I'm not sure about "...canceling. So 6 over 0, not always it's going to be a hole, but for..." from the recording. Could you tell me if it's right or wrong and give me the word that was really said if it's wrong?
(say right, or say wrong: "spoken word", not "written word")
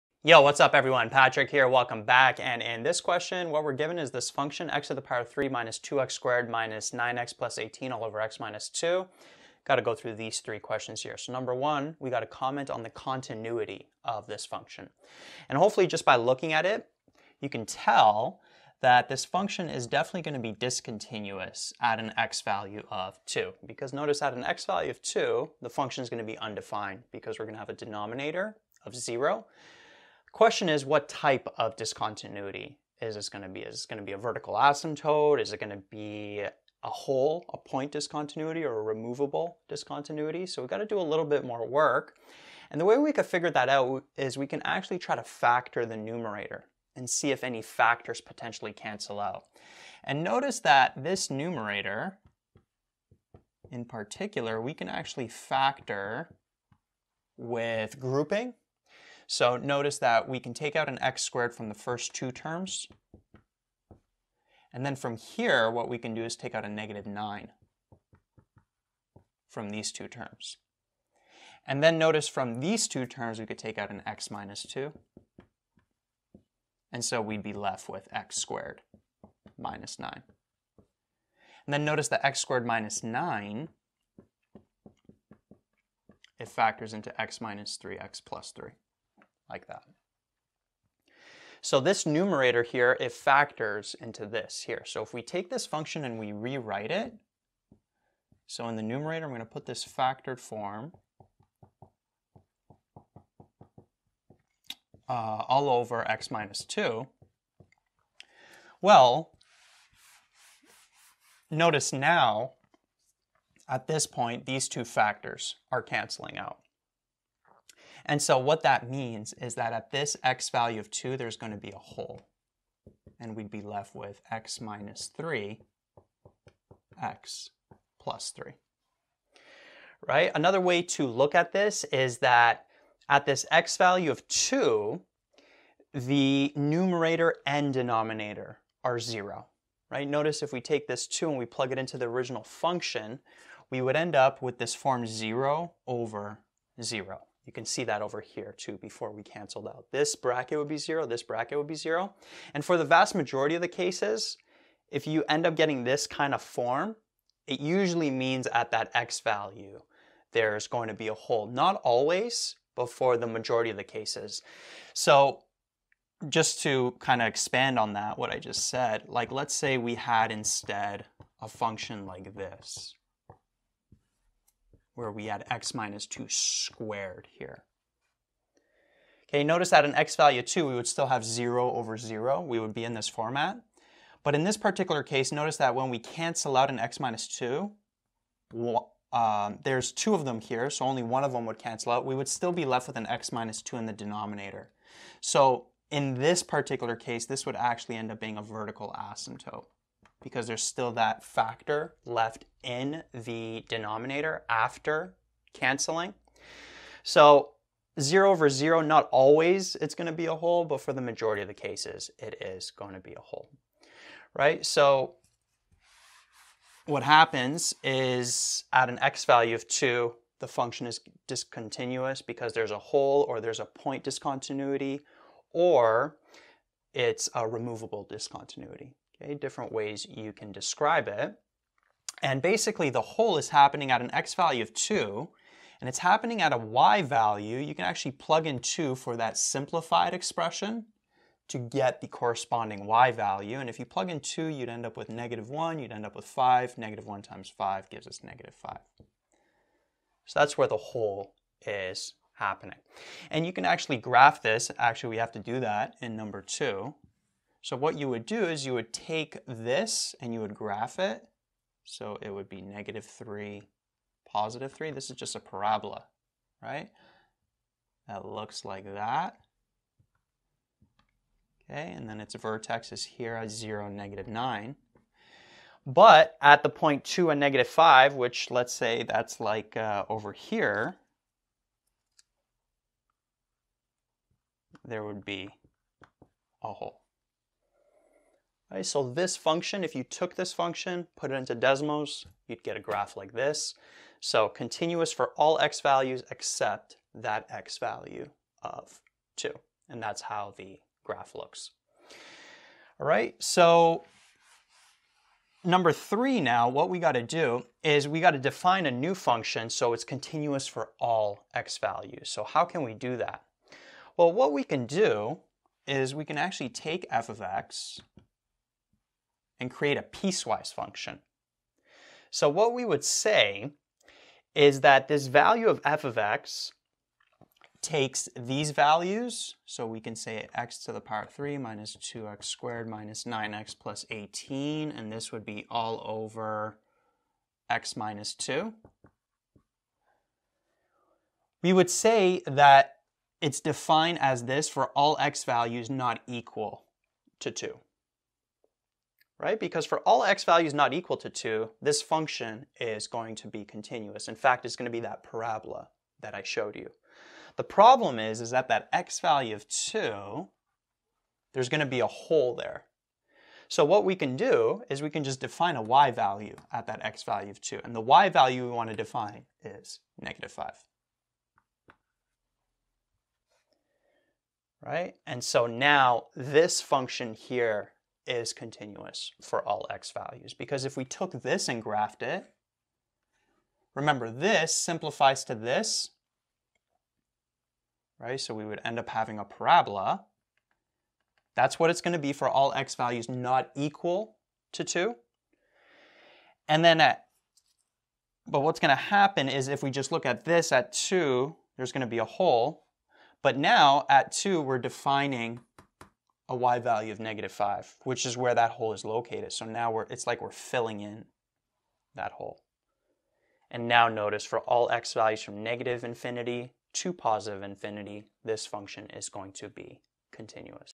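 wrong: "0", not "6".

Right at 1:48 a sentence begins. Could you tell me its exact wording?
Well, notice now, at this point, these two factors are canceling out.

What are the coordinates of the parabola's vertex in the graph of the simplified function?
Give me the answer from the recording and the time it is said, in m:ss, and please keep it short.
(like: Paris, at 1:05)
(0, -9), at 4:33.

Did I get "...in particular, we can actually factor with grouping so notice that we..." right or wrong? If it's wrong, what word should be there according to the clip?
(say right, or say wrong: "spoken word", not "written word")
right.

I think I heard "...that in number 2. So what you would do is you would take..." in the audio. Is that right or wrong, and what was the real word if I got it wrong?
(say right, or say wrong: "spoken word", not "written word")
right.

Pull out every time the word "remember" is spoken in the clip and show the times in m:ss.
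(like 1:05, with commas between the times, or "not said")
6:23.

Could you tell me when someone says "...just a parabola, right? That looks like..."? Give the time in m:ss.
4:25.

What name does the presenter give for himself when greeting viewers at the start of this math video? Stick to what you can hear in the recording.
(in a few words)
Patrick.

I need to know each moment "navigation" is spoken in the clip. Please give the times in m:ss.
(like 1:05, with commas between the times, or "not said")
not said.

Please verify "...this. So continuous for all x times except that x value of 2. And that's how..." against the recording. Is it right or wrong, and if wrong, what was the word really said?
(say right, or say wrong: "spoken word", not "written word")
wrong: "values", not "times".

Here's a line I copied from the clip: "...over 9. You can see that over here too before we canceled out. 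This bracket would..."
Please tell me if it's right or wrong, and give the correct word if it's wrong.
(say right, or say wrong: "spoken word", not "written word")
wrong: "0", not "9".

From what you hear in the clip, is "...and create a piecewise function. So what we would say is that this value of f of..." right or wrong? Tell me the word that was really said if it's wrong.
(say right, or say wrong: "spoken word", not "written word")
right.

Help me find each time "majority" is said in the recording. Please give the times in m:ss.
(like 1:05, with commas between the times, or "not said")
2:33, 2:43, 3:31.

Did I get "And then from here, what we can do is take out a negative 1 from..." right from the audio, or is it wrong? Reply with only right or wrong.
wrong.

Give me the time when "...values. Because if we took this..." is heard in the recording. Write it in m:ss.
6:20.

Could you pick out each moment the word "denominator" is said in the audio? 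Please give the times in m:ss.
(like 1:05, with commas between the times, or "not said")
0:27, 2:17, 3:13, 3:23.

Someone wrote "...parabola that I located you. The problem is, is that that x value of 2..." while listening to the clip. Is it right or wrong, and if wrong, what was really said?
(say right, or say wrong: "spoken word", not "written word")
wrong: "showed", not "located".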